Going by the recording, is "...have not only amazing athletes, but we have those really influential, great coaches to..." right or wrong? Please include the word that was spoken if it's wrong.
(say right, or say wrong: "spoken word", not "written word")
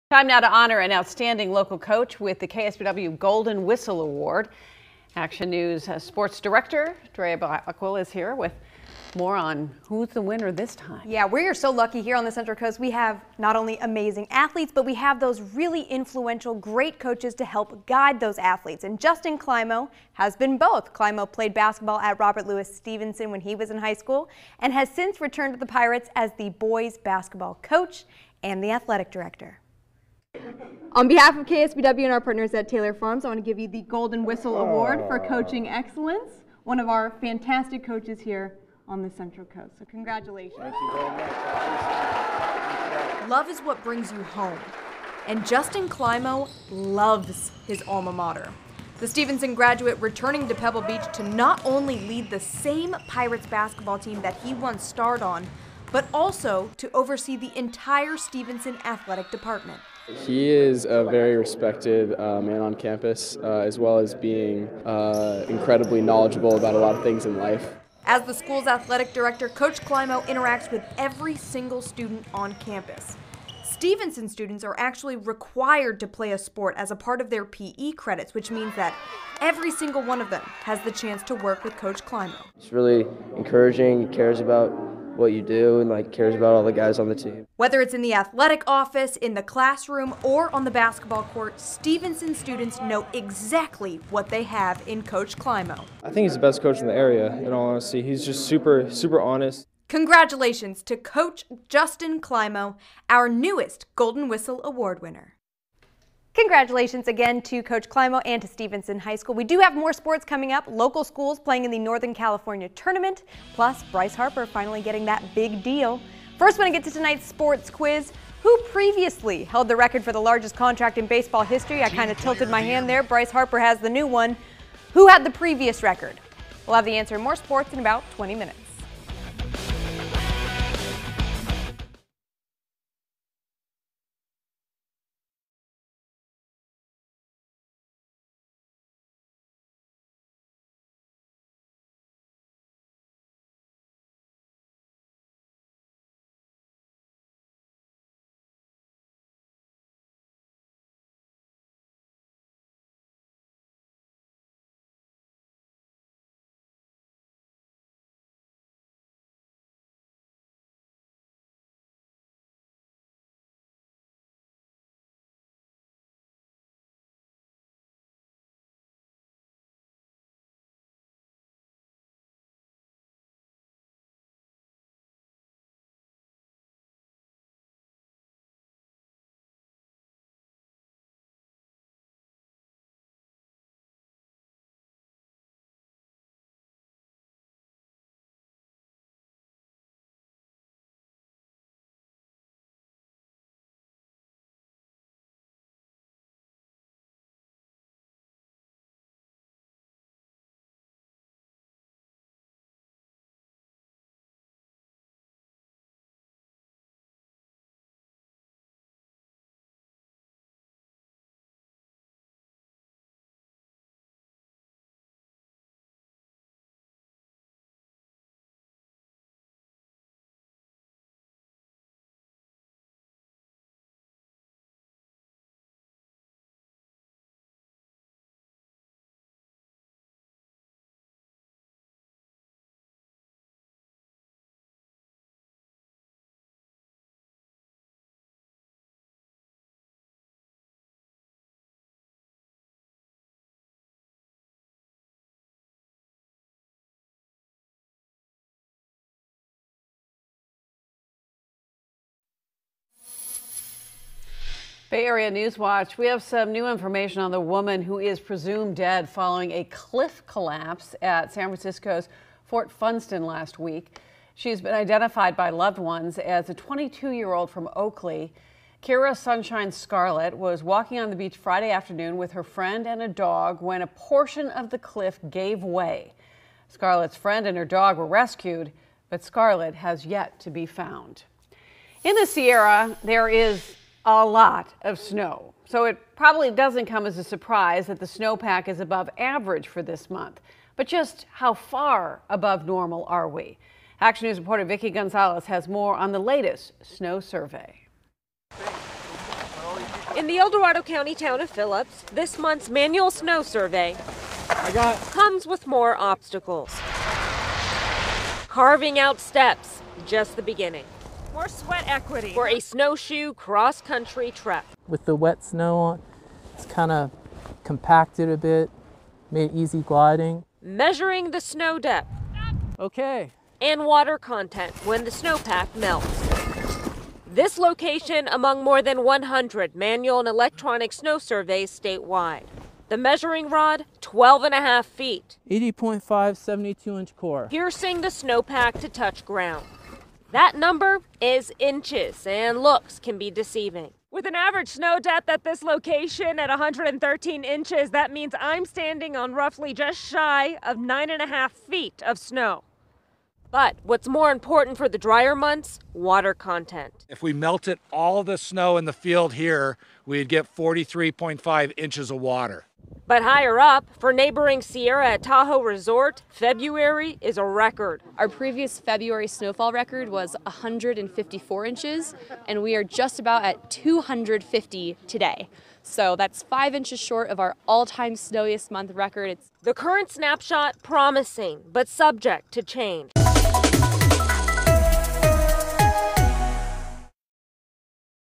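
right.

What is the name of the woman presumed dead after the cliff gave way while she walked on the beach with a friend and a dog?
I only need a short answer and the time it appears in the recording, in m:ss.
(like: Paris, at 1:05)
Kira Sunshine Scarlett, at 4:28.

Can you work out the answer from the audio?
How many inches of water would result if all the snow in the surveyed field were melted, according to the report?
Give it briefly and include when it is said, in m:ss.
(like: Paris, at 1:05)
43.5 inches, at 6:00.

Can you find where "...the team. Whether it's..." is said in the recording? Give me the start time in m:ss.
1:27.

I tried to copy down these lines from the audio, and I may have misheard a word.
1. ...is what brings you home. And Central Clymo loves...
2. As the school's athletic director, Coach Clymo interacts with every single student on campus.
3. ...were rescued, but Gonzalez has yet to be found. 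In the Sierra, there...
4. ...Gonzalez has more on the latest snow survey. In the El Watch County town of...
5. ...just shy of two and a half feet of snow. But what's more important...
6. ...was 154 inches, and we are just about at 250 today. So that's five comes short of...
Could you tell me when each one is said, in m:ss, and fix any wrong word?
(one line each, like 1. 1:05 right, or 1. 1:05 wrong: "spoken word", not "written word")
1. 0:43 wrong: "Justin", not "Central"
2. 1:08 right
3. 4:37 wrong: "Scarlett", not "Gonzalez"
4. 4:54 wrong: "Dorado", not "Watch"
5. 5:49 wrong: "nine", not "two"
6. 6:10 wrong: "inches", not "comes".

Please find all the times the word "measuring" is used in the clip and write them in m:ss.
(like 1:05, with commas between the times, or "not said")
5:20, 5:32.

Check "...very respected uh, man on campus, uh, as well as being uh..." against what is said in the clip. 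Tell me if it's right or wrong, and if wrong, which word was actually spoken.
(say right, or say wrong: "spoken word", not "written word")
right.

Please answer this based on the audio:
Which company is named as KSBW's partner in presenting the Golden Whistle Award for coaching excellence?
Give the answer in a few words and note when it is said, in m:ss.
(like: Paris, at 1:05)
Taylor Farms, at 0:32.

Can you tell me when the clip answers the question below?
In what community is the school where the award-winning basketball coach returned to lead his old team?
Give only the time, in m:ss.
0:50.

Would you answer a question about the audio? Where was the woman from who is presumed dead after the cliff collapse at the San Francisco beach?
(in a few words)
Oakley.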